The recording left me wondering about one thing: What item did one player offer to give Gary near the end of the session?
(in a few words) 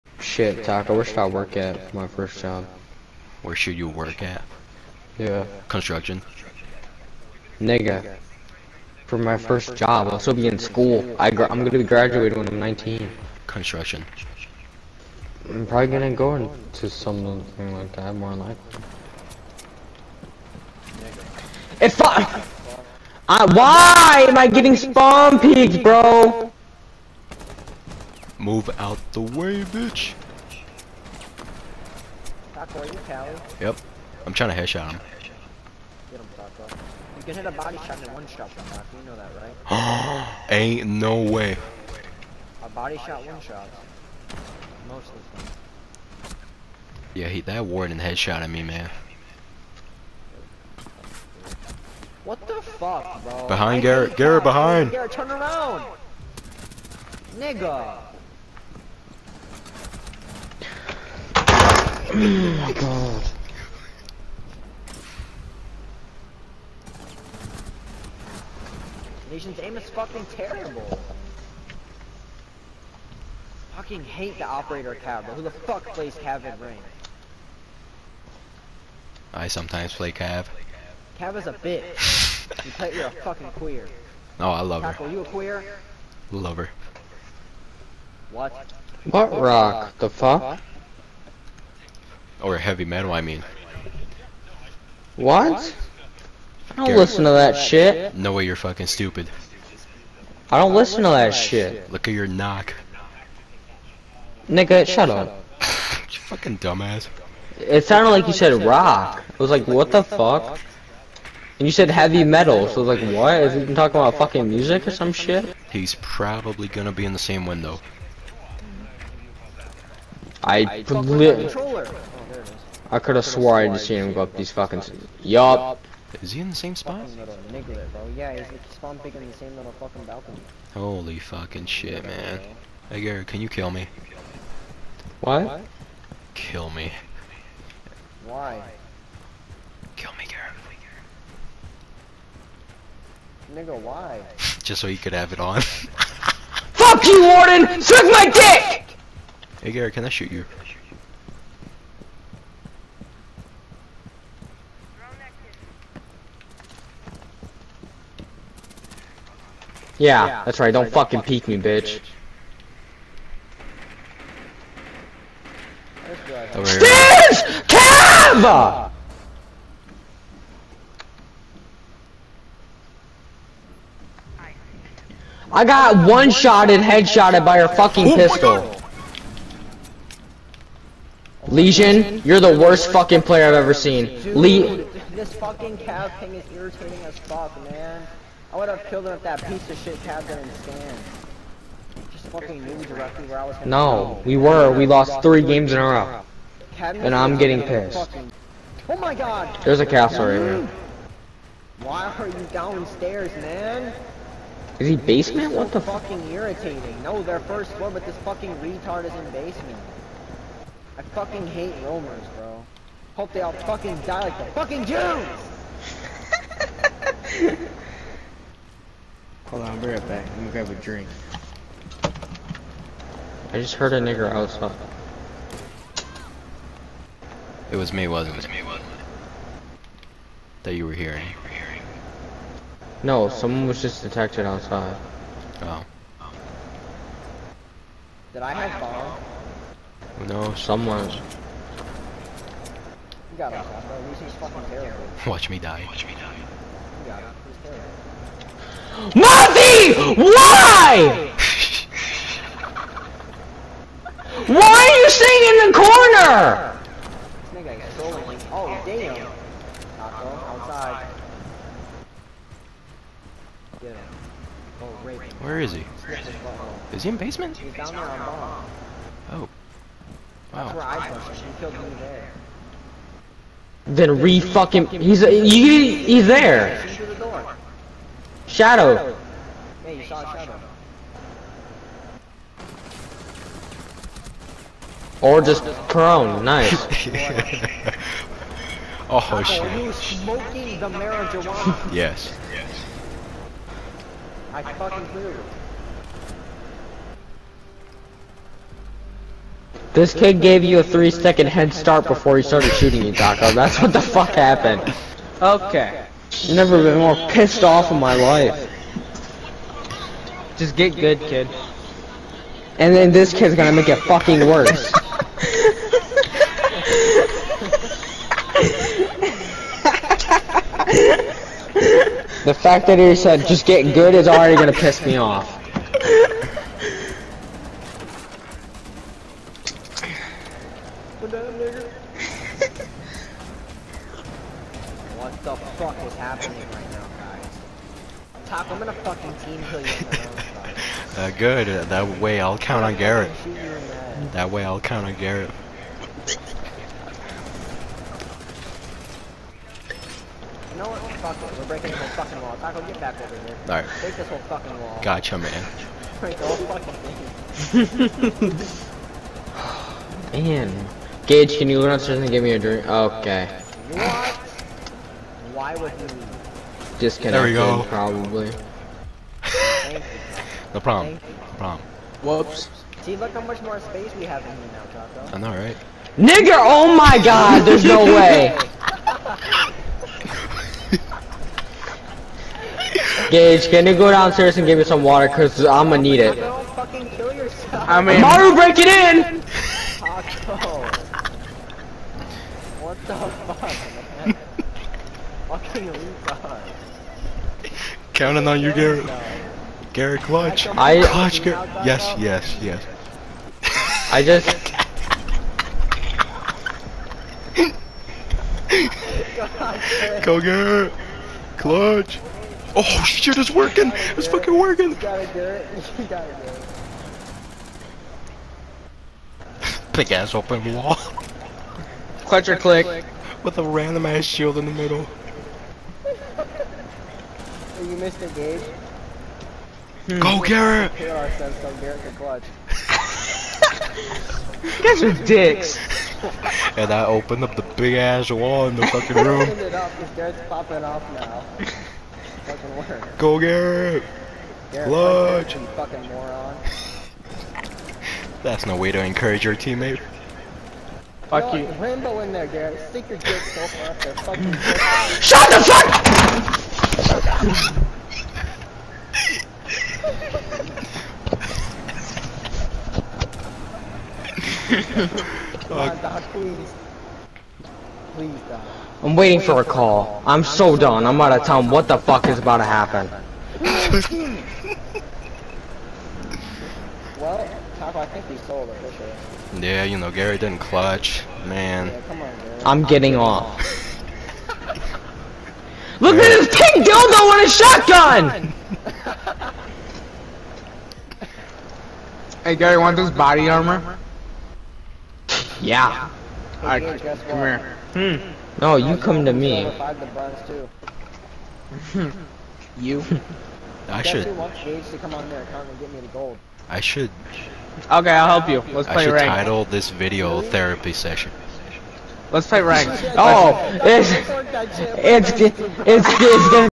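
Body armor.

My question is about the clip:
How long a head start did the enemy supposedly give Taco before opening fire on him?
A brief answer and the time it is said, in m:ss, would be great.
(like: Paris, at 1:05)
3 seconds, at 5:00.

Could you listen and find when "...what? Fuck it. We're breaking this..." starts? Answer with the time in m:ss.
5:50.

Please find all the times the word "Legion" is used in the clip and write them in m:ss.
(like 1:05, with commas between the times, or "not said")
3:01.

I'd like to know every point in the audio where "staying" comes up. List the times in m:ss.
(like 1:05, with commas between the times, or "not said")
4:15.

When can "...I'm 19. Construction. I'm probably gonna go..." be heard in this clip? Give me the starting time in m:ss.
0:12.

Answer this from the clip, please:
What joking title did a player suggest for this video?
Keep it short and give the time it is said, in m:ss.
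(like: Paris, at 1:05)
Therapy session, at 8:30.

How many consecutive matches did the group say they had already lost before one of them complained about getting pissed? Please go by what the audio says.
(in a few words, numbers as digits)
3.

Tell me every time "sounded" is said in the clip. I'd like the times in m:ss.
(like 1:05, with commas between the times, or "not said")
1:47.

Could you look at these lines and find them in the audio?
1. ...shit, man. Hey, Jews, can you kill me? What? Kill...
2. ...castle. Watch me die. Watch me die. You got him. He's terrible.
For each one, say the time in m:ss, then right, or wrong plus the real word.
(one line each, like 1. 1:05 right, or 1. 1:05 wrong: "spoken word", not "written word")
1. 2:11 wrong: "Gary", not "Jews"
2. 4:04 wrong: "terrible", not "castle".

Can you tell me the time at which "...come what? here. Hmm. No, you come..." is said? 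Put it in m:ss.
8:17.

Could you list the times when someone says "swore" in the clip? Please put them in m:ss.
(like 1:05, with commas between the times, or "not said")
2:03.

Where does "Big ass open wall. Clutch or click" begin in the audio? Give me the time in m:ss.
6:59.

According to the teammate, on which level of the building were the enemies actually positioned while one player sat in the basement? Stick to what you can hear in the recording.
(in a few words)
First floor.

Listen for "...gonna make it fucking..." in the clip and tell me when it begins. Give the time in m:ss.
5:13.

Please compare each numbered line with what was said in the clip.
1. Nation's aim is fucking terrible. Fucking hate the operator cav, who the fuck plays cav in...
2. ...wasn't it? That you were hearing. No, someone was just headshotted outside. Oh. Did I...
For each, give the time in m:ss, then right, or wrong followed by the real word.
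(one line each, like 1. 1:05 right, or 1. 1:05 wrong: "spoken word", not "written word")
1. 1:09 right
2. 3:48 wrong: "detected", not "headshotted".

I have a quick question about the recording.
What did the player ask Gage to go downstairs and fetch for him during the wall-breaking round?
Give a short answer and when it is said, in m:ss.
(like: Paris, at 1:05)
Water, at 6:25.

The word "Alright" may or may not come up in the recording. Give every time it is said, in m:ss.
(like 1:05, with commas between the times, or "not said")
5:53, 8:16.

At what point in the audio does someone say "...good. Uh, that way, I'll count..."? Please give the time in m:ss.
5:41.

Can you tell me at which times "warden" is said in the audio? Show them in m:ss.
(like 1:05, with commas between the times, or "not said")
0:47, 2:27.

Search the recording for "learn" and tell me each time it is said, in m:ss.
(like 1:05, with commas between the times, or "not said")
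6:01.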